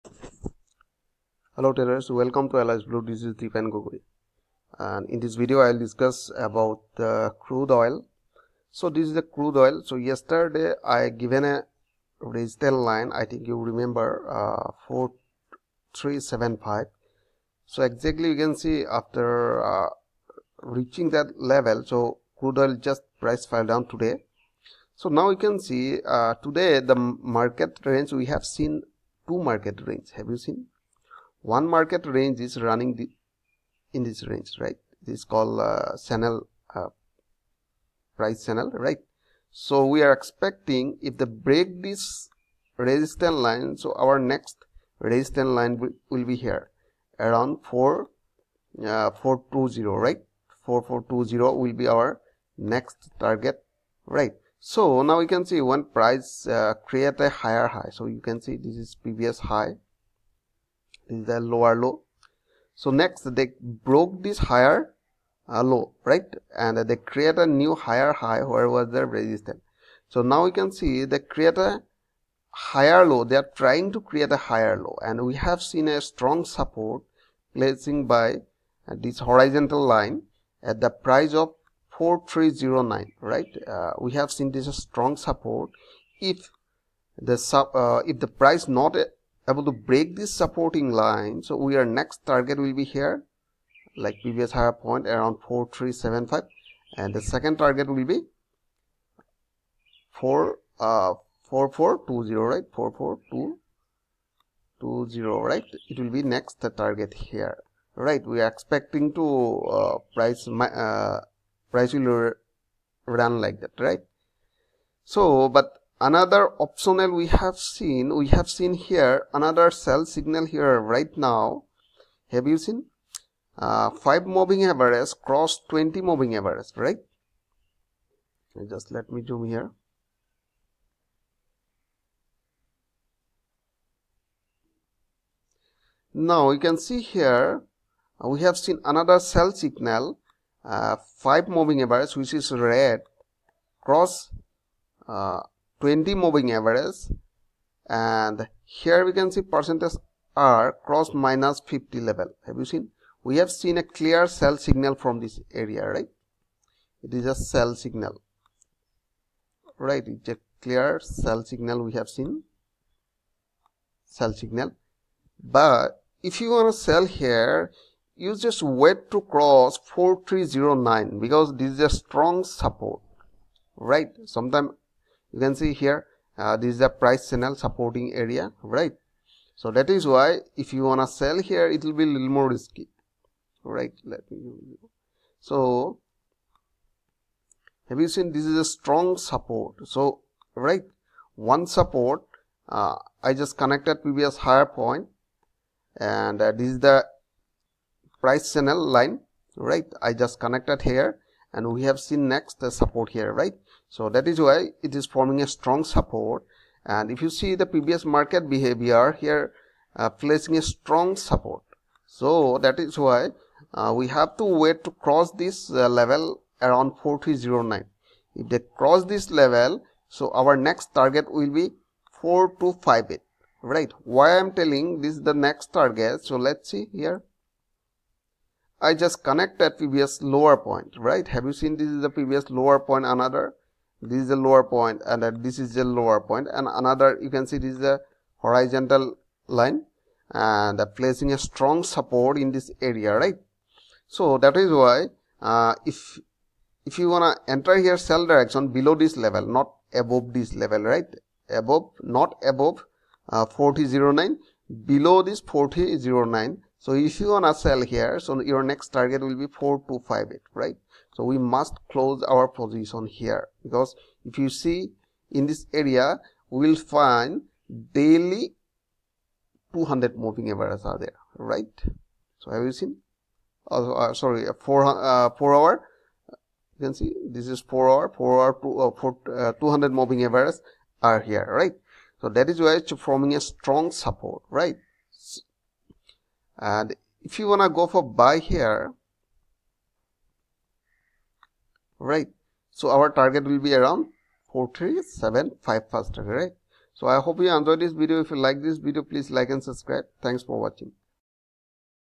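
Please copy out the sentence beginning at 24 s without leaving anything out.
So now you can see uh, today the market range we have seen two market range.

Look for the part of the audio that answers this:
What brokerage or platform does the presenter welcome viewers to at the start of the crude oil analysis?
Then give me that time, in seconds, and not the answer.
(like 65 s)
2 s.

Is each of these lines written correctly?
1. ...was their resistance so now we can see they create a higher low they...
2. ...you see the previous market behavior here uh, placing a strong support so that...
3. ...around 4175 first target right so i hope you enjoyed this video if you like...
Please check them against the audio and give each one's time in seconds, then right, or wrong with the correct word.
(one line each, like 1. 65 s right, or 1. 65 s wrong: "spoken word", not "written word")
1. 68 s right
2. 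207 s right
3. 293 s wrong: "4375", not "4175".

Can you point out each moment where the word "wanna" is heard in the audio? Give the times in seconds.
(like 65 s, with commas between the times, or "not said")
180 s, 247 s, 257 s, 287 s.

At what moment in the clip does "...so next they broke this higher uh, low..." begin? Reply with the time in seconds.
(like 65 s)
62 s.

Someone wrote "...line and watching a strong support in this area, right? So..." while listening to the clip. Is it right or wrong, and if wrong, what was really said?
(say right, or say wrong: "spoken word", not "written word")
wrong: "placing", not "watching".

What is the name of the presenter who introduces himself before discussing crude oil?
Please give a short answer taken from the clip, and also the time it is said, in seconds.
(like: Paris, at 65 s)
Deepan Gogoi, at 3 s.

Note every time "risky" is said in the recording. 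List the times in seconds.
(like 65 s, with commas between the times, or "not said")
182 s.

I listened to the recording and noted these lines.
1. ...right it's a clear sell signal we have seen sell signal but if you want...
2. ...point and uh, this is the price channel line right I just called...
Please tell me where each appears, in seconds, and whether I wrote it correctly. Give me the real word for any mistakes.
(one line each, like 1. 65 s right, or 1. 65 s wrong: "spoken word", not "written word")
1. 159 s right
2. 194 s wrong: "connected", not "called".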